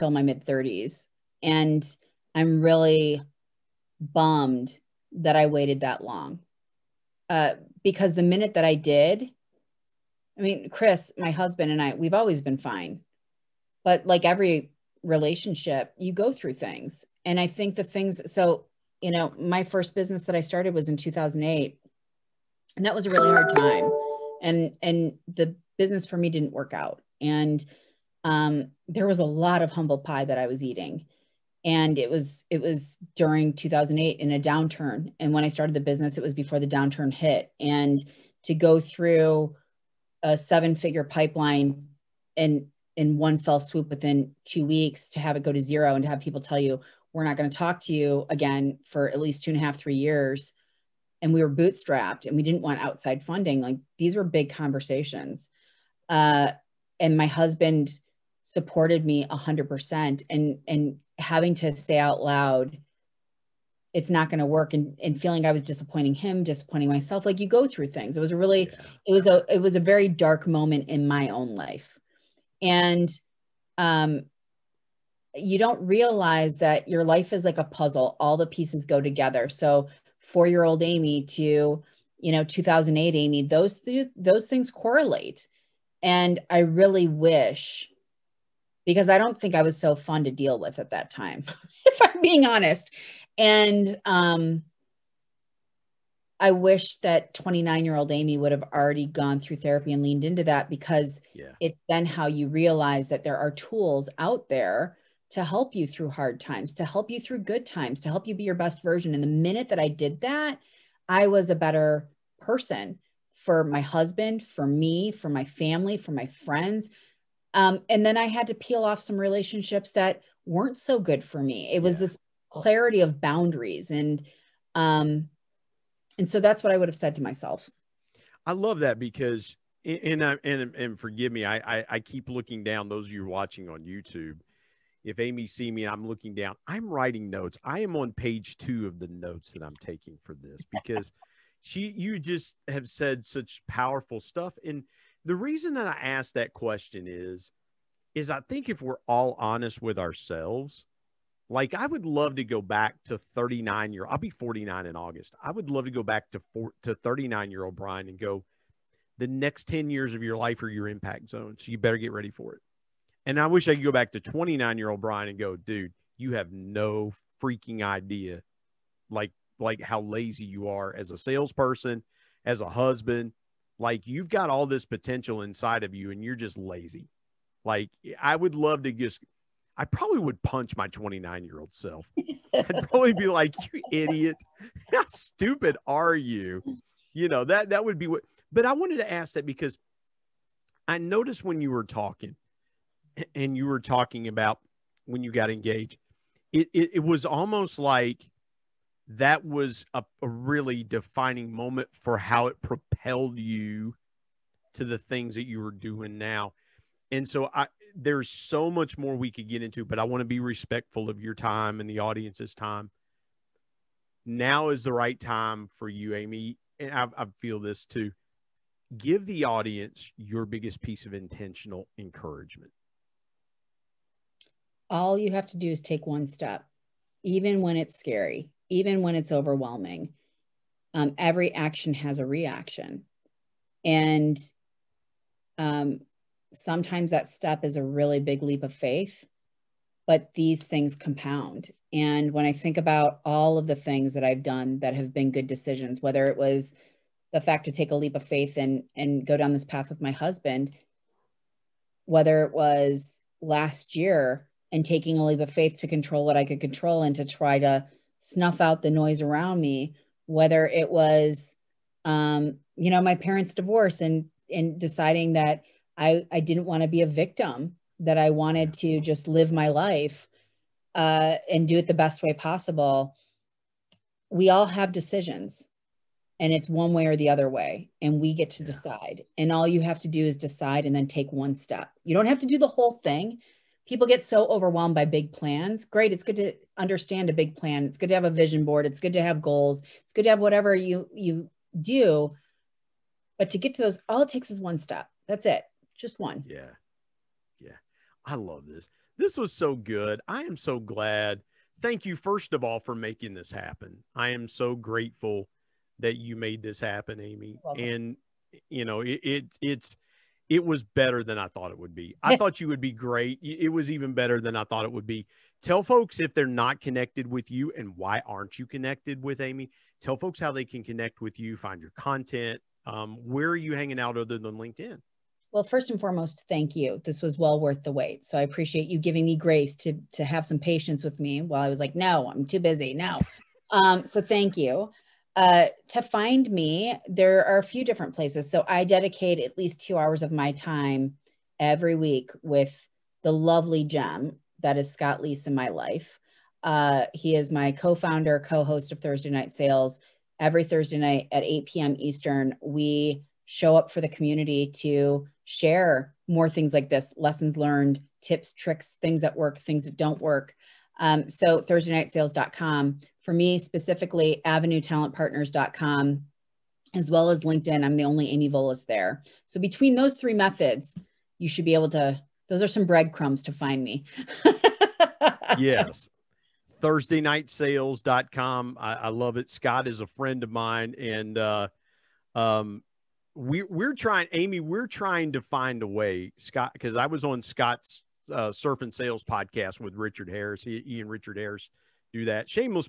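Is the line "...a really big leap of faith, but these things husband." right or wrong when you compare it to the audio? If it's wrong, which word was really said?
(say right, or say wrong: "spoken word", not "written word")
wrong: "compound", not "husband".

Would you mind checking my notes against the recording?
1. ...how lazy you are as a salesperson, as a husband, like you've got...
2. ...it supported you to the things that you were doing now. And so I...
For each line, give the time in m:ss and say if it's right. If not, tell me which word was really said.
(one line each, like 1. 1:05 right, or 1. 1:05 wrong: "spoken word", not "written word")
1. 2:49 right
2. 3:22 wrong: "propelled", not "supported".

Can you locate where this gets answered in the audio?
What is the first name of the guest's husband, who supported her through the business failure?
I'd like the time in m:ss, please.
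0:10.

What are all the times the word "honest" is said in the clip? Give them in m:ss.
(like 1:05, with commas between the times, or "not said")
1:32, 2:29.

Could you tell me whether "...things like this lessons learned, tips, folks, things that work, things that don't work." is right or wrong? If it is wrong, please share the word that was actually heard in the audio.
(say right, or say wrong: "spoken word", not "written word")
wrong: "tricks", not "folks".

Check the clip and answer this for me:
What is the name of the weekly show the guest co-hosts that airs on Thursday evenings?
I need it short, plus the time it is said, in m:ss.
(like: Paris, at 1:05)
Thursday Night Sales, at 5:48.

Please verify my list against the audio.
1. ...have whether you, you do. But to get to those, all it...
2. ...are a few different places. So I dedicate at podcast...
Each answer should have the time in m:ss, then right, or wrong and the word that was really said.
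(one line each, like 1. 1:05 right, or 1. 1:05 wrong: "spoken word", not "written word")
1. 4:50 wrong: "whatever", not "whether"
2. 5:37 wrong: "least", not "podcast".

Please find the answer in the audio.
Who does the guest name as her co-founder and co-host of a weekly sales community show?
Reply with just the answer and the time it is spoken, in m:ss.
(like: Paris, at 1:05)
Scott Leese, at 5:44.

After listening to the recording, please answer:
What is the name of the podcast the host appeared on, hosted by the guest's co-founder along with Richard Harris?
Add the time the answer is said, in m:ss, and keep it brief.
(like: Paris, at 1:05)
Surf and Sales, at 6:28.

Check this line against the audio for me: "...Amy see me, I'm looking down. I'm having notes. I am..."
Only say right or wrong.
wrong.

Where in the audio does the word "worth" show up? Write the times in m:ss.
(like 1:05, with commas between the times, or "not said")
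5:27.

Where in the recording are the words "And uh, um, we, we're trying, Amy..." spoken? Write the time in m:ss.
6:20.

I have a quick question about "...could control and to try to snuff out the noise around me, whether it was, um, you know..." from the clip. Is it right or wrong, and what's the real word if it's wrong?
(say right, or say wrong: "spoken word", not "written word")
right.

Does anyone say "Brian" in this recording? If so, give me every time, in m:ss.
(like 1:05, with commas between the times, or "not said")
2:37, 2:44.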